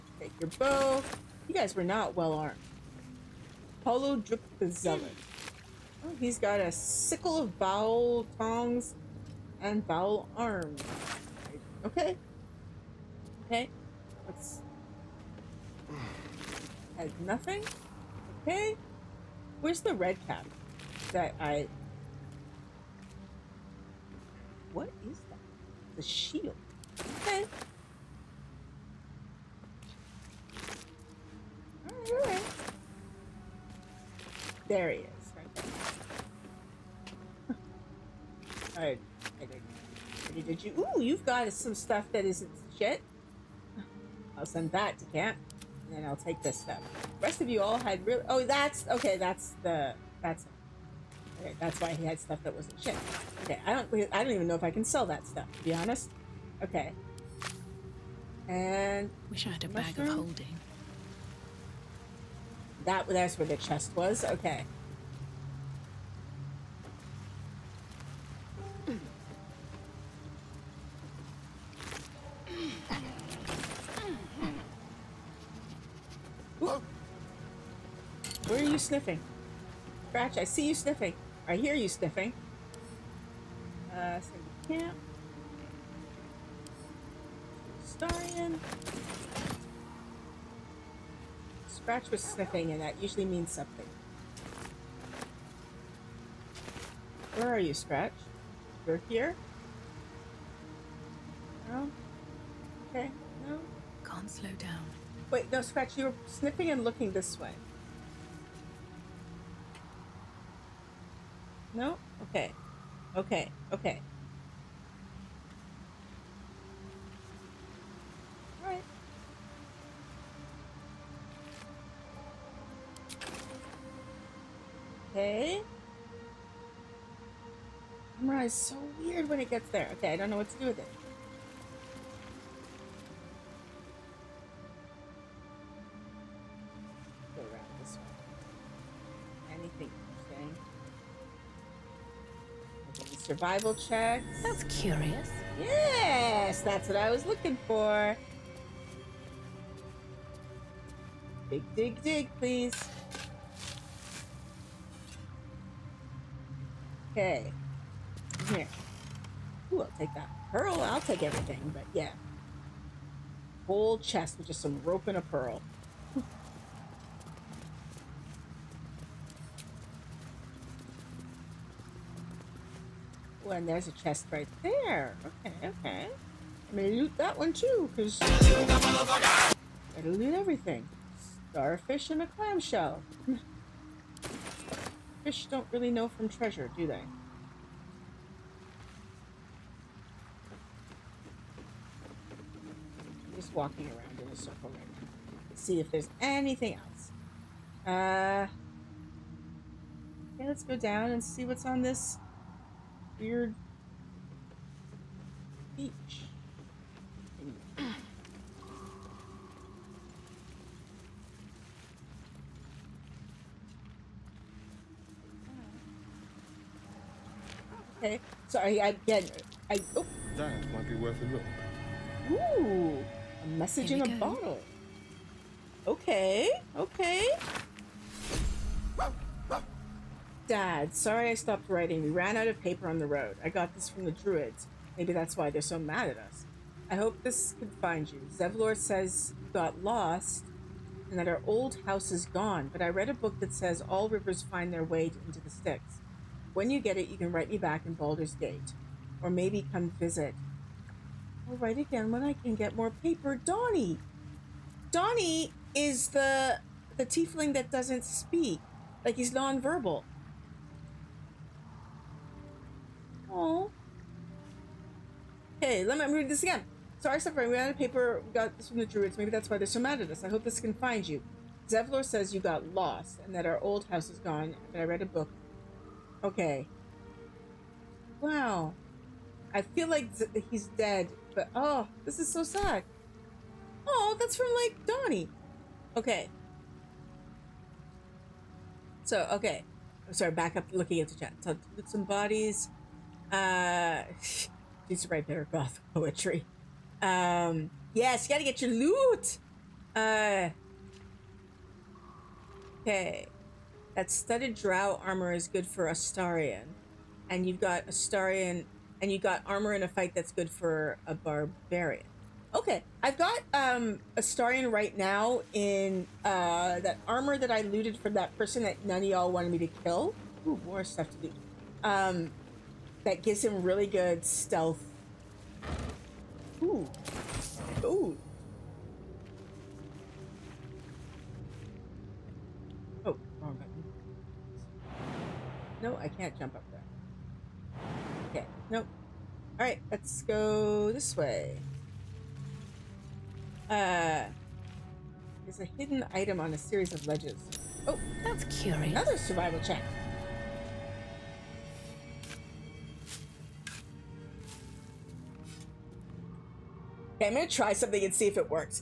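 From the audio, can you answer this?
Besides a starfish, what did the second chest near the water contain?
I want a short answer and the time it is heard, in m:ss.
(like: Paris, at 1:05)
A clamshell, at 3:02.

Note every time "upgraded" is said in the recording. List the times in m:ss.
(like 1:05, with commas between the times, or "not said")
not said.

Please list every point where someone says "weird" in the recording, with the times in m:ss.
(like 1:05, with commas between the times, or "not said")
2:08, 3:23.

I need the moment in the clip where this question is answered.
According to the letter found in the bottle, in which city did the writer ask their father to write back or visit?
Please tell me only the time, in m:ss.
4:07.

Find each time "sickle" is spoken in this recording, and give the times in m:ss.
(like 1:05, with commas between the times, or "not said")
0:06.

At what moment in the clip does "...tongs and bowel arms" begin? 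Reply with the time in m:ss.
0:08.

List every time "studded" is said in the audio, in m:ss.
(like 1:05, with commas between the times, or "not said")
5:04.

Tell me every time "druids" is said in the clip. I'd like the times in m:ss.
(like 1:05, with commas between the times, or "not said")
3:54, 4:28.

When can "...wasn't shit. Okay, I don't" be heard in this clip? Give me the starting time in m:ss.
0:52.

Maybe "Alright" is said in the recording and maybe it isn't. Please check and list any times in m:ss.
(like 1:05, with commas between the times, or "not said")
0:38, 5:39.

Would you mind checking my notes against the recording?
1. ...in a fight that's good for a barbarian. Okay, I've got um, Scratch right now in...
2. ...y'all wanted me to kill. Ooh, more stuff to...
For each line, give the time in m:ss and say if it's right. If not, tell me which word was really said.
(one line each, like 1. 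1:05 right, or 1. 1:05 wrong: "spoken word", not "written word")
1. 5:09 wrong: "Astarion", not "Scratch"
2. 5:19 right.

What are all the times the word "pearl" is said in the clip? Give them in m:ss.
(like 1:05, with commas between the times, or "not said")
2:40, 2:45.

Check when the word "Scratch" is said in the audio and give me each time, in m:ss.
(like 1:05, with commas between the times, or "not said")
1:20, 1:31, 1:37, 1:45.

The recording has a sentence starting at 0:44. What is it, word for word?
I'll send that to camp, and then I'll take this stuff.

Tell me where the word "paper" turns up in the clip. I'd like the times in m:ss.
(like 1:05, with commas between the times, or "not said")
3:52, 4:12, 4:27.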